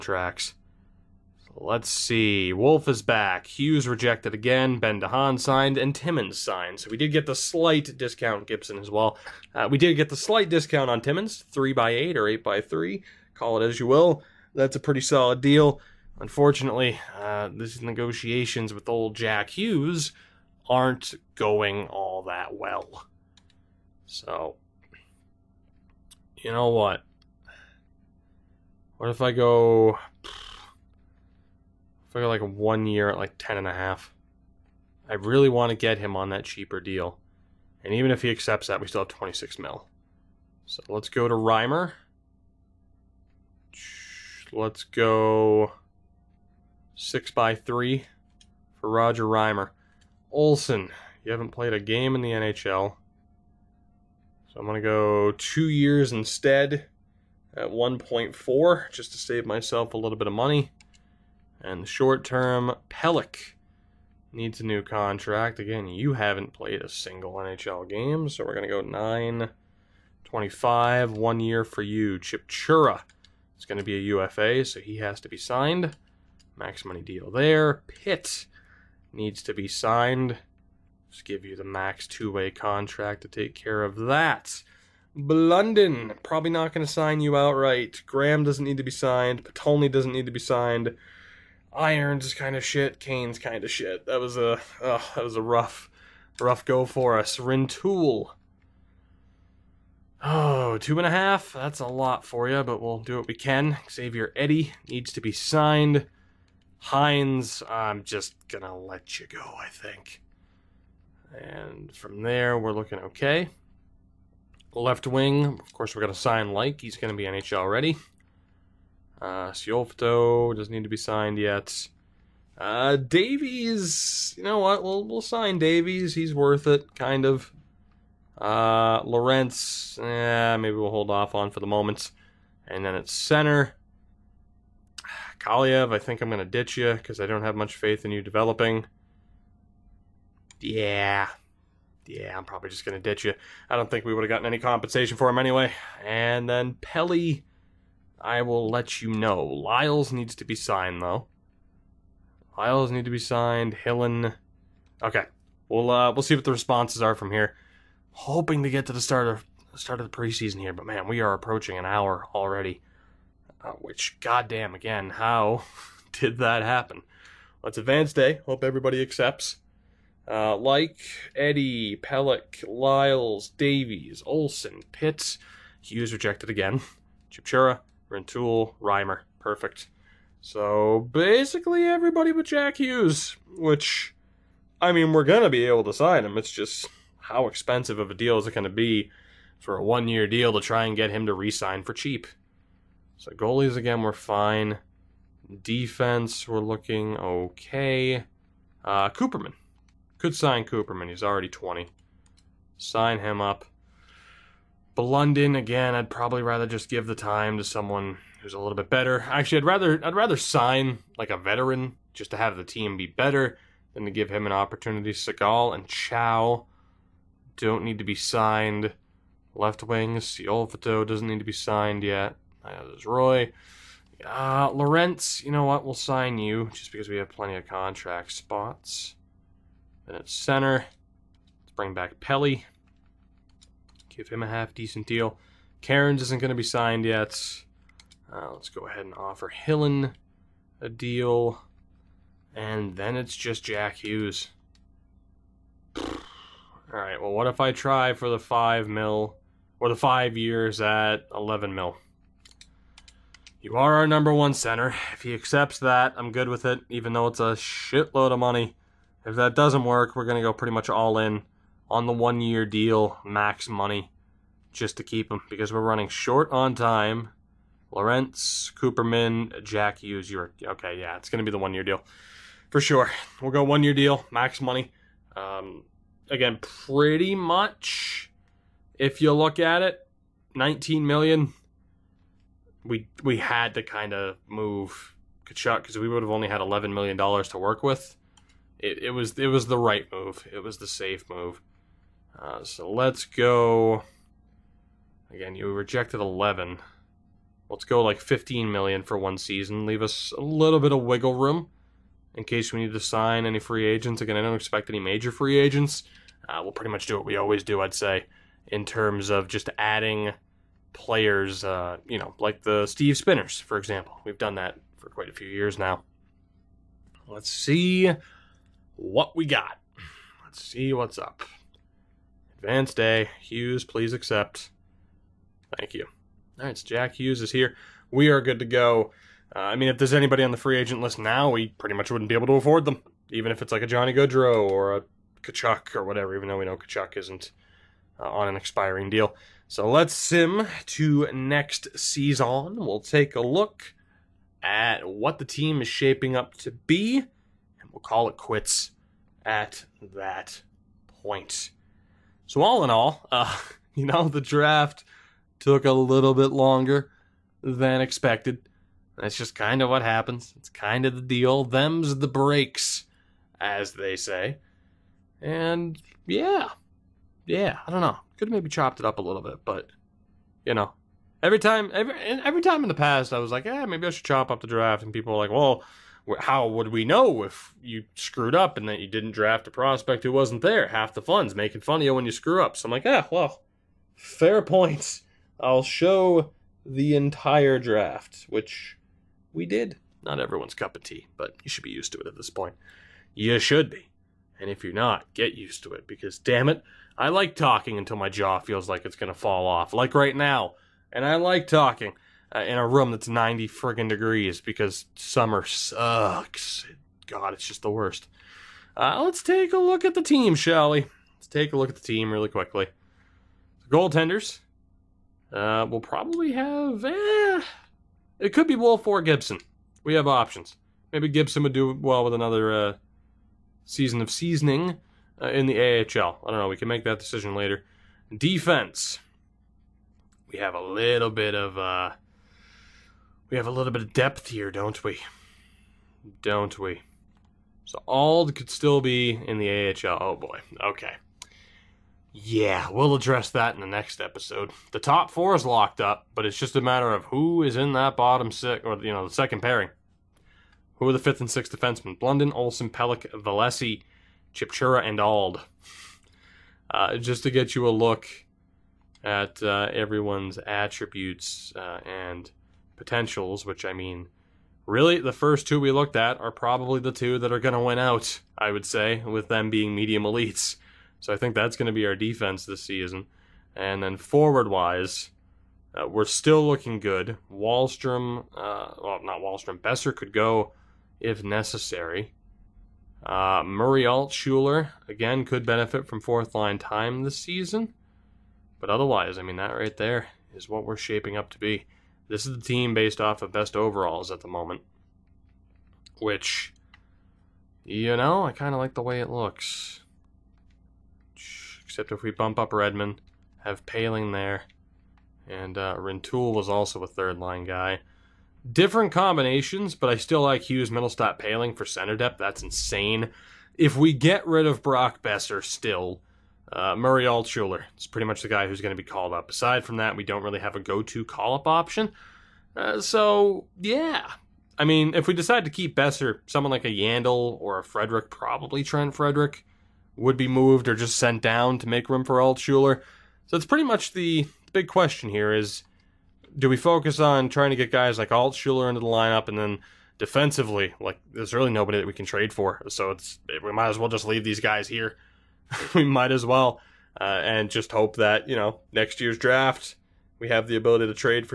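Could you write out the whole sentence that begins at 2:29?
Lyles needs to be signed, though.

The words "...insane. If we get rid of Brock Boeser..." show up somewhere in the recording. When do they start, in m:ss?
8:32.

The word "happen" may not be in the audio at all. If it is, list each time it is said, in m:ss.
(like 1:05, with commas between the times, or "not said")
2:46, 6:00.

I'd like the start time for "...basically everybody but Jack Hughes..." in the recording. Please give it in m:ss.
3:01.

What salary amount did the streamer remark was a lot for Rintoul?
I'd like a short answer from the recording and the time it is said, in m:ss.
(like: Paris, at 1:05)
2.5, at 1:40.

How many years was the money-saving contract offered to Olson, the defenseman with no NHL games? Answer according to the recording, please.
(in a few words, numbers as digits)
2 years.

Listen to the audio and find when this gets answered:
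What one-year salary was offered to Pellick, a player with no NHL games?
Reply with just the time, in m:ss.
1:08.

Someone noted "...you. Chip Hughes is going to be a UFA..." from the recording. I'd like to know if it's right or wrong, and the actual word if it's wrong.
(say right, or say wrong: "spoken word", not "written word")
wrong: "Chura", not "Hughes".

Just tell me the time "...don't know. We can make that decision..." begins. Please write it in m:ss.
7:06.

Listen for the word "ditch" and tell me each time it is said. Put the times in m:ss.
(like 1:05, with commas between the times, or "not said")
2:16, 2:23.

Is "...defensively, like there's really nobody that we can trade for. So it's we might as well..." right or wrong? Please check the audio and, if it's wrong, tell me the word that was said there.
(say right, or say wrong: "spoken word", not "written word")
right.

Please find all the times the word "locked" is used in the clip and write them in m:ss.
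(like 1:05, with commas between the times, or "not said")
7:25.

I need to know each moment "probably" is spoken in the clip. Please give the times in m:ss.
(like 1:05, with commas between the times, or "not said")
1:26, 2:22, 3:26, 6:56, 7:46, 8:48.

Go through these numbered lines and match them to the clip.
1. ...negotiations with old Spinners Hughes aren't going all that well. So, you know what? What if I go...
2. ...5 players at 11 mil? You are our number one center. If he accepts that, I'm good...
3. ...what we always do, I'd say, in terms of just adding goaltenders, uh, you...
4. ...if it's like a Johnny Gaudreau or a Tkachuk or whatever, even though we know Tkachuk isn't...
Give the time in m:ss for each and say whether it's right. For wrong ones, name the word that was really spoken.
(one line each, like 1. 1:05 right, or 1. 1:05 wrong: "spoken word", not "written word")
1. 0:17 wrong: "Jack", not "Spinners"
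2. 4:09 wrong: "years", not "players"
3. 5:07 wrong: "players", not "goaltenders"
4. 5:33 right.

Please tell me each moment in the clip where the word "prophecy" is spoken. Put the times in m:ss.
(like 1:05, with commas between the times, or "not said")
not said.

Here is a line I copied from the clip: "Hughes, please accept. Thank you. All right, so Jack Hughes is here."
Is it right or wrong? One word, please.
right.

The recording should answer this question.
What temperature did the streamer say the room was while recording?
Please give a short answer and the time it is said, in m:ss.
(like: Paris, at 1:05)
90 degrees, at 6:43.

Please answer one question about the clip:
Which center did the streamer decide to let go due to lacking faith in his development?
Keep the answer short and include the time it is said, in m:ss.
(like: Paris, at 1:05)
Kaliev, at 2:15.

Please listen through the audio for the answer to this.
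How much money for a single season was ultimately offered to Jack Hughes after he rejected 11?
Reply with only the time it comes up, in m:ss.
4:58.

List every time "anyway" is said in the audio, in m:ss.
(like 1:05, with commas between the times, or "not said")
2:25.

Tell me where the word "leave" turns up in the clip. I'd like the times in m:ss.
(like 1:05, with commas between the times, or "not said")
4:59, 9:04.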